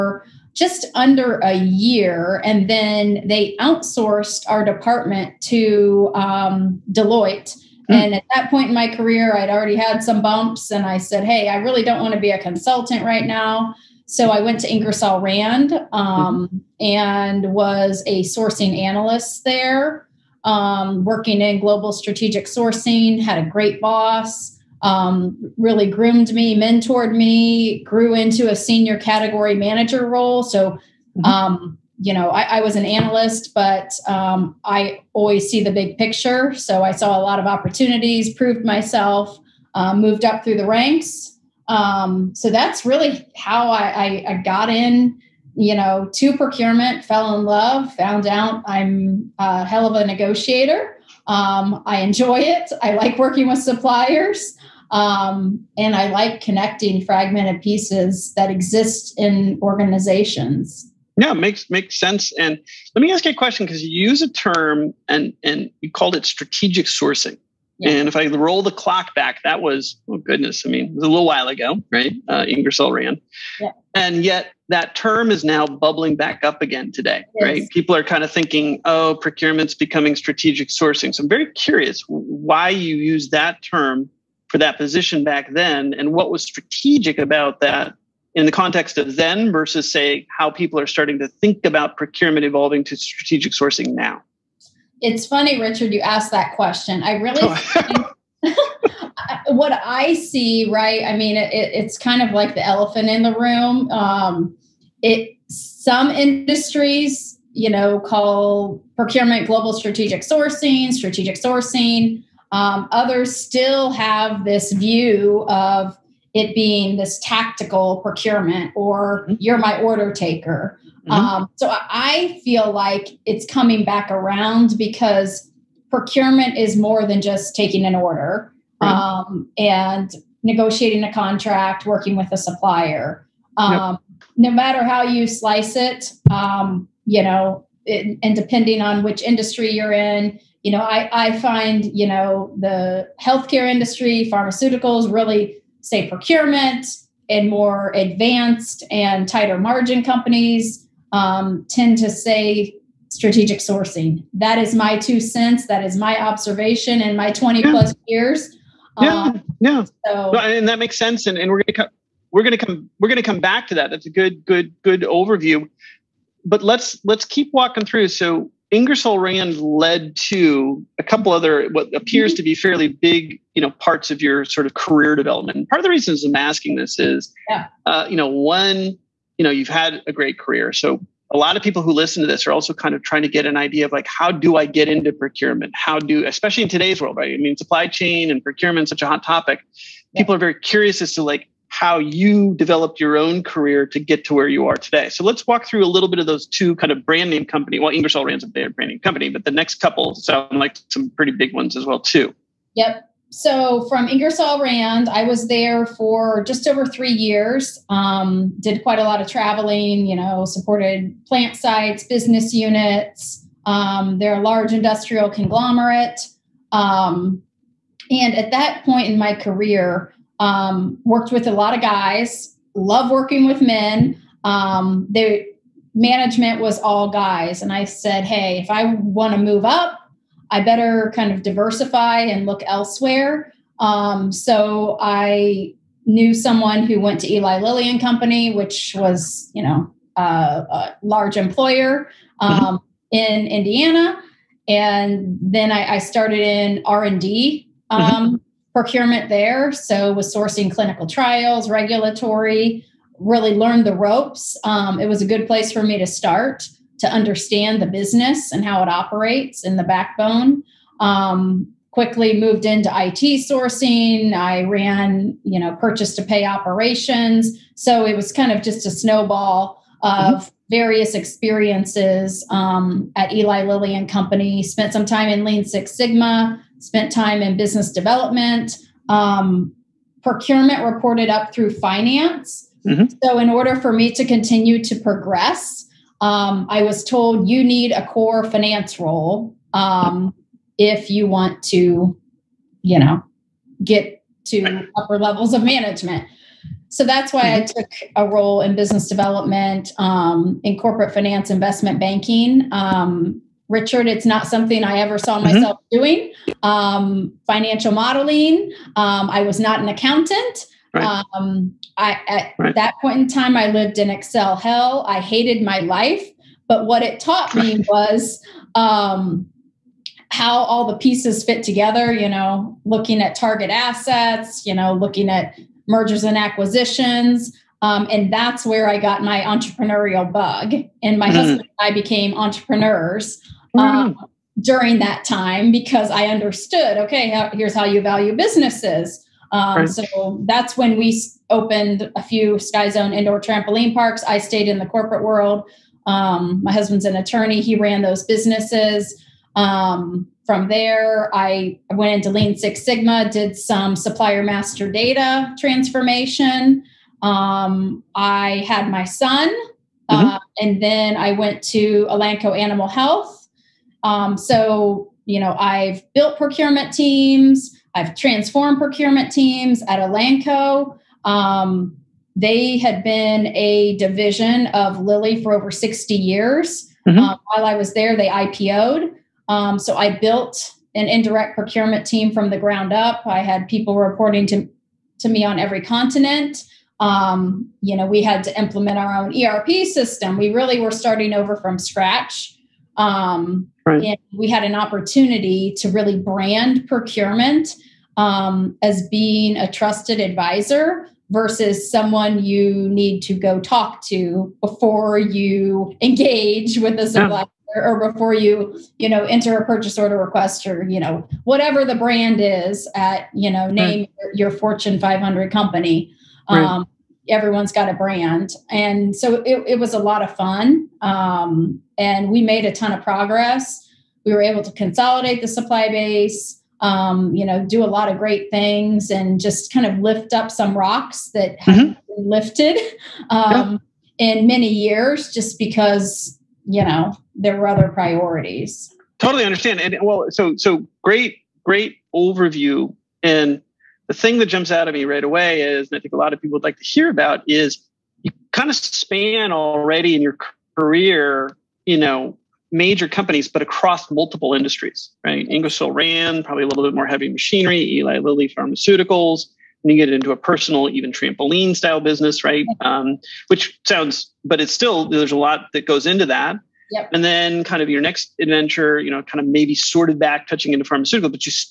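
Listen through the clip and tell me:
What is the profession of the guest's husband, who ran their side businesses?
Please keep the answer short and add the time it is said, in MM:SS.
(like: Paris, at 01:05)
Attorney, at 05:47.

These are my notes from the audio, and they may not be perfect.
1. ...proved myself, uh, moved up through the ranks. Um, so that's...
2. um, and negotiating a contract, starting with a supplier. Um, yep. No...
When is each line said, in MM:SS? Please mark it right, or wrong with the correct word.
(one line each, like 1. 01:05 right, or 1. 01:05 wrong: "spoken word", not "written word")
1. 00:38 right
2. 02:08 wrong: "working", not "starting".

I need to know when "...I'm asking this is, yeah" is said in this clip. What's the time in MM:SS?
02:56.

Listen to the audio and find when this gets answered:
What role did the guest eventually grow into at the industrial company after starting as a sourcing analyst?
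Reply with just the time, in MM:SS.
00:28.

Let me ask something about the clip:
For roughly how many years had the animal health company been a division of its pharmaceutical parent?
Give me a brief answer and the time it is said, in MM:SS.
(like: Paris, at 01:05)
Over 60 years, at 06:15.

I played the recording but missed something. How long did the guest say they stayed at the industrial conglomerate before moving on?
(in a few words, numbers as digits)
Just over three years.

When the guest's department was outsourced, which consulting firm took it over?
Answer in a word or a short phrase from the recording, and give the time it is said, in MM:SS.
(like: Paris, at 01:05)
Deloitte, at 00:06.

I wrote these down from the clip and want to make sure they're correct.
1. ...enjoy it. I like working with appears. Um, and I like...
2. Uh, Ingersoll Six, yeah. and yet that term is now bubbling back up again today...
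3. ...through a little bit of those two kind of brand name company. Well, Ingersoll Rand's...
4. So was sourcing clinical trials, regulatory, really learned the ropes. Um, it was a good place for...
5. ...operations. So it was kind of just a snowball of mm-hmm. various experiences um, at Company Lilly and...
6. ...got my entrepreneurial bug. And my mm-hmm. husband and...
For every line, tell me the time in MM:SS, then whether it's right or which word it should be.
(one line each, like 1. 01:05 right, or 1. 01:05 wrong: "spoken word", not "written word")
1. 00:52 wrong: "suppliers", not "appears"
2. 01:12 wrong: "Rand", not "Six"
3. 03:15 right
4. 04:09 right
5. 04:26 wrong: "Eli", not "Company"
6. 05:28 right.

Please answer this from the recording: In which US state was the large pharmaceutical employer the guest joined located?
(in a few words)
Indiana.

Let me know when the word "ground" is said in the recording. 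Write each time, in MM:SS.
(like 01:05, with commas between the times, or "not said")
06:22.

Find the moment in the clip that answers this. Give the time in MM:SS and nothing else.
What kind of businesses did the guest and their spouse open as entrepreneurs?
05:42.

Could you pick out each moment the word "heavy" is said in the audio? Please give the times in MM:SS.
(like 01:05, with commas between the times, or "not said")
07:37.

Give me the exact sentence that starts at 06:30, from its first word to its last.
We really were starting over from scratch.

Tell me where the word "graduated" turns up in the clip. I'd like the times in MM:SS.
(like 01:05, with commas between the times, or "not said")
not said.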